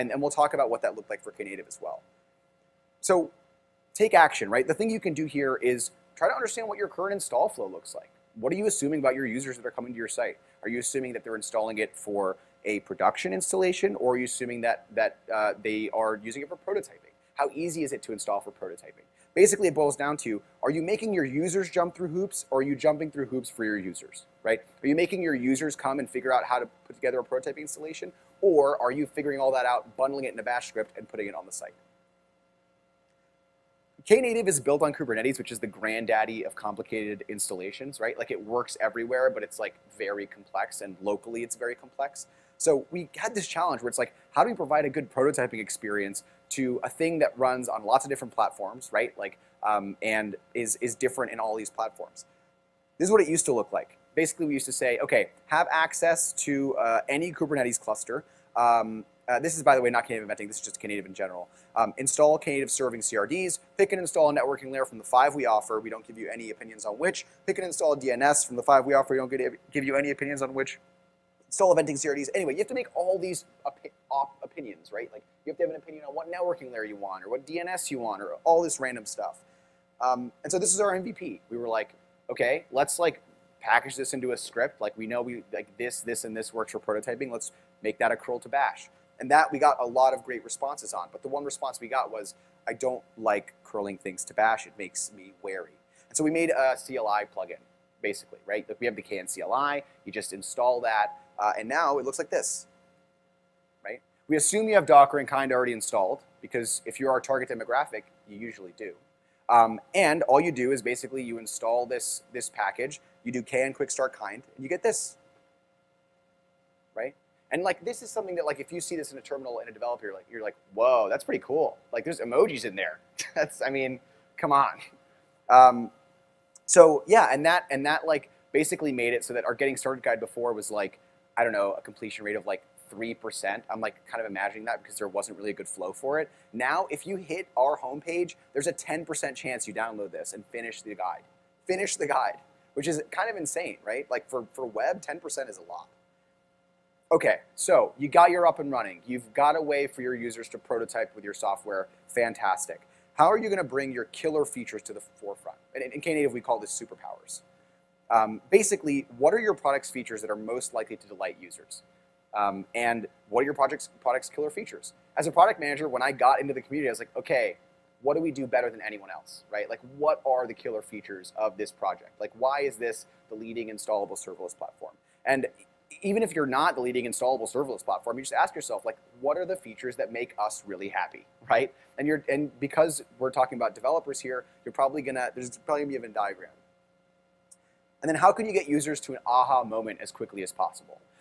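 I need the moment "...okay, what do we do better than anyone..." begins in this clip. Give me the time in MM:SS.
02:47.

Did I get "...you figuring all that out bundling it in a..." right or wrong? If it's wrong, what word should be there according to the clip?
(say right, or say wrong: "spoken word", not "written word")
right.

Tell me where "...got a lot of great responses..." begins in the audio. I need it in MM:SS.
01:29.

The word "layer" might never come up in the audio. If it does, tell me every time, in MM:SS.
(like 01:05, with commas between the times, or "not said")
01:04, 01:16.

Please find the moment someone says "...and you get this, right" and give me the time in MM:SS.
01:54.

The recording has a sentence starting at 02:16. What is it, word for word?
Now, if you hit our homepage, there's a 10% chance you download this and finish the guide.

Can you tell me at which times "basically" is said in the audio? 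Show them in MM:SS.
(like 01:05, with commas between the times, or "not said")
00:19, 00:54, 01:38, 01:50, 02:08, 02:38.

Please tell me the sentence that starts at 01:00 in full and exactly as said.
This is just Knative in general.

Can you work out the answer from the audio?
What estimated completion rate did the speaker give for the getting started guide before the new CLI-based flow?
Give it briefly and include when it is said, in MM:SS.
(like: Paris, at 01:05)
3%, at 02:12.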